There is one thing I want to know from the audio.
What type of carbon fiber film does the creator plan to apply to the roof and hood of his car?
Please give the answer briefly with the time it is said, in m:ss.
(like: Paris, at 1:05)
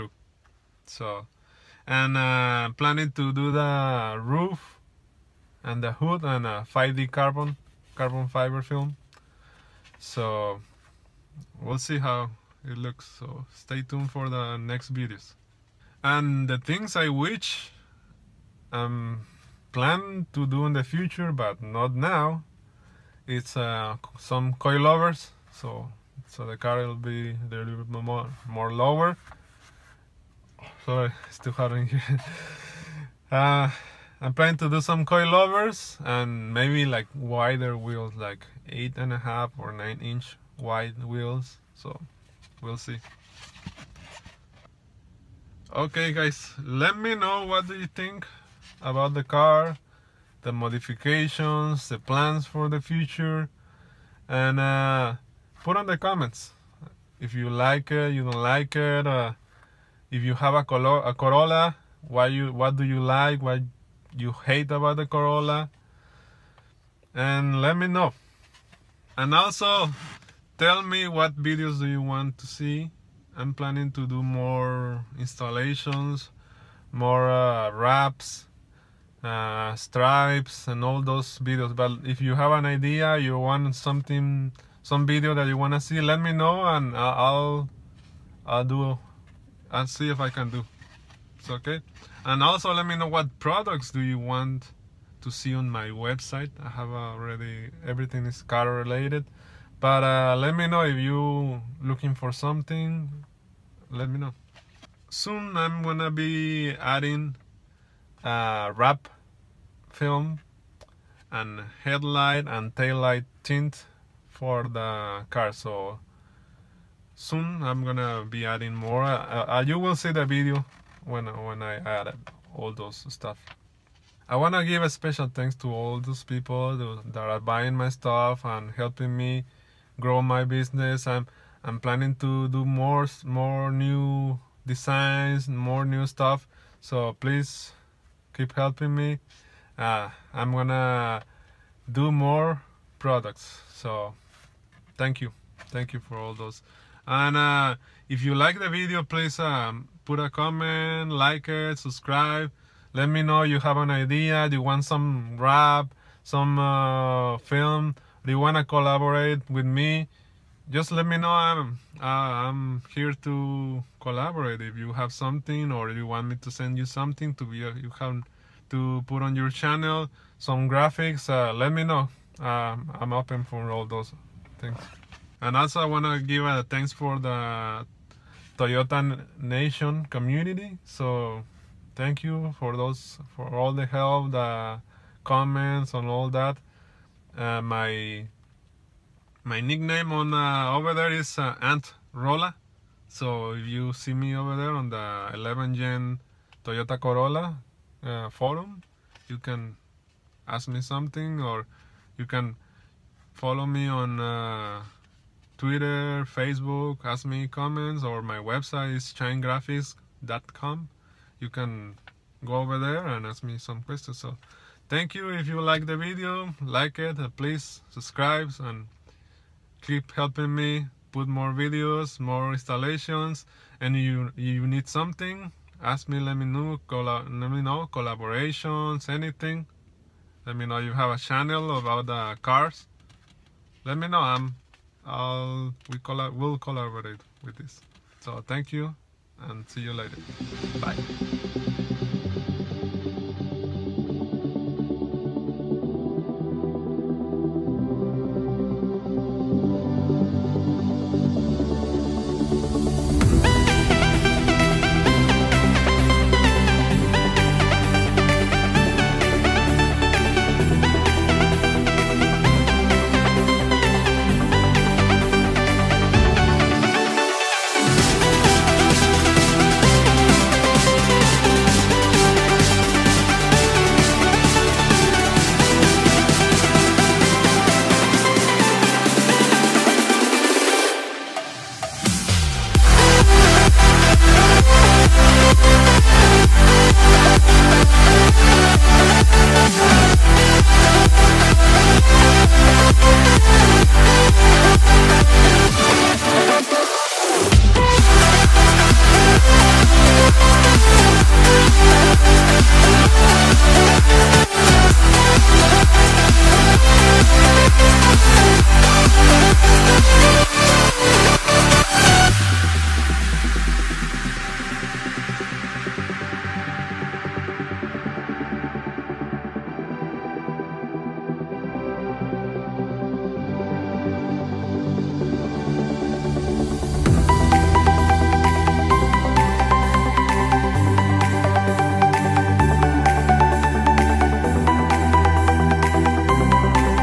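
5D, at 0:06.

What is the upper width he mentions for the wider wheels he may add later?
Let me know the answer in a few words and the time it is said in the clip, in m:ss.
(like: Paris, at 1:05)
9 inch, at 0:39.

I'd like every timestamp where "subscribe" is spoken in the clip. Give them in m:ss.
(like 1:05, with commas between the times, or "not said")
2:31, 3:37.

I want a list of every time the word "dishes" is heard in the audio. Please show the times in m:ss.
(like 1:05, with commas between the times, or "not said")
not said.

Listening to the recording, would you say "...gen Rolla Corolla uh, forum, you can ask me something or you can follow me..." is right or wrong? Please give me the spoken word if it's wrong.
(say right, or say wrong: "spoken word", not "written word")
wrong: "Toyota", not "Rolla".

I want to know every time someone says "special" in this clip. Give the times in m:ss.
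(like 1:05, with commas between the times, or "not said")
2:04.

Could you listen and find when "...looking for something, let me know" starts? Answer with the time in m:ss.
1:41.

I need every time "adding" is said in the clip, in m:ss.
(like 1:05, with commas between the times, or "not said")
1:46, 1:58.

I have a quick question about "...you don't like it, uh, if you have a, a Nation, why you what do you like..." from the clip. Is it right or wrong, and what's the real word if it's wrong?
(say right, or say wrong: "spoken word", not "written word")
wrong: "Corolla", not "Nation".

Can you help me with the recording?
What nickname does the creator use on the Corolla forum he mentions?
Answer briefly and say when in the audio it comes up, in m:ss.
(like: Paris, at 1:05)
Ant Rolla, at 3:11.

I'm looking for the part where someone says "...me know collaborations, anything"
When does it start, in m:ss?
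3:47.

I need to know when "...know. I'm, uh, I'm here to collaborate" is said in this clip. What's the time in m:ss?
2:41.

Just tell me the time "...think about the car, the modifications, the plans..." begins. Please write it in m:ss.
0:47.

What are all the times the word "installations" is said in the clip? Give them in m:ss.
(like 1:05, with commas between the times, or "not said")
1:15, 3:42.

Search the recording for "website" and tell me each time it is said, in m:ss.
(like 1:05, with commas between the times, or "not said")
1:35, 3:28.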